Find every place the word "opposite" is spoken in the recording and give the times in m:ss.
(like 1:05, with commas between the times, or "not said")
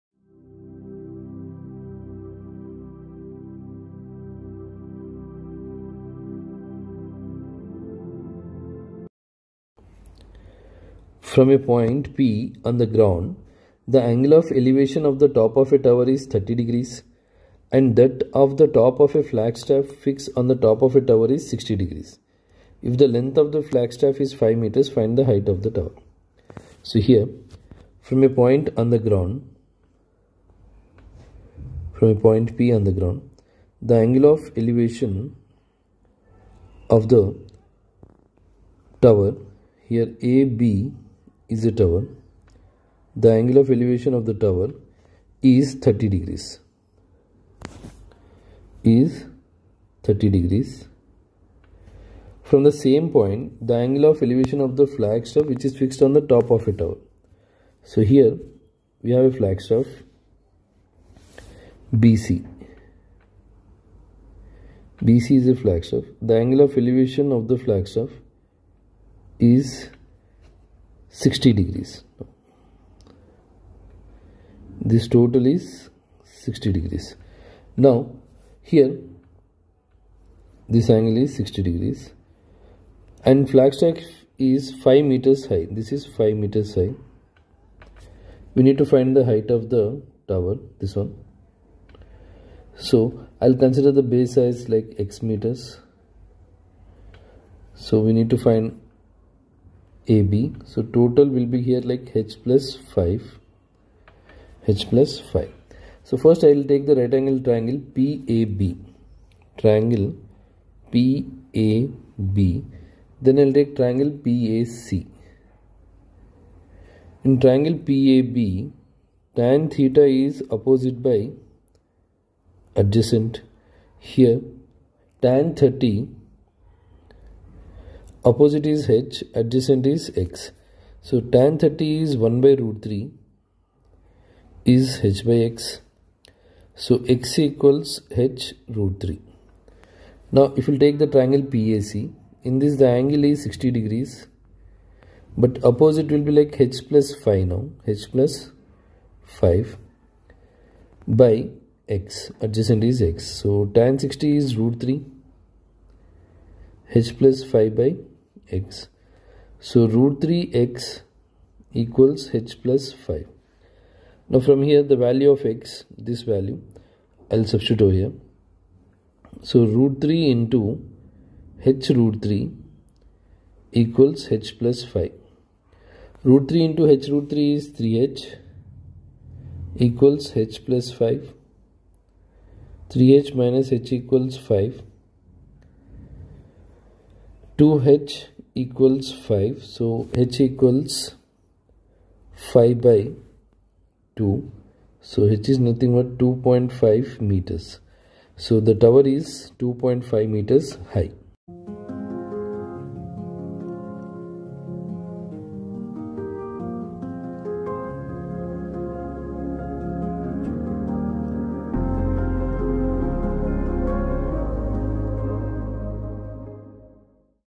2:00, 2:08, 2:25.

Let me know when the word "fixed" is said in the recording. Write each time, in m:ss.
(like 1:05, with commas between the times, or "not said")
0:20, 0:55.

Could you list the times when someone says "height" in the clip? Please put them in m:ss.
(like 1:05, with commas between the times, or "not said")
0:25, 1:29.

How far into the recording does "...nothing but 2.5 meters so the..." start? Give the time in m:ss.
3:15.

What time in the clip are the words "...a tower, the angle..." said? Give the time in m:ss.
0:41.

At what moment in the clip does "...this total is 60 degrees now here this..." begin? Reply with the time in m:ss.
1:14.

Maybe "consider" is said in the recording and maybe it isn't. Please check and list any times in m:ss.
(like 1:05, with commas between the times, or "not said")
1:33.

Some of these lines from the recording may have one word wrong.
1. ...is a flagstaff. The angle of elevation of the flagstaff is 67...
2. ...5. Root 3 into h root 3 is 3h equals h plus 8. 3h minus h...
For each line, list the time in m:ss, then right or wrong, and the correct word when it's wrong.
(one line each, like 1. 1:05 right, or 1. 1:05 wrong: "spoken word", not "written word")
1. 1:05 wrong: "60", not "67"
2. 2:54 wrong: "5", not "8".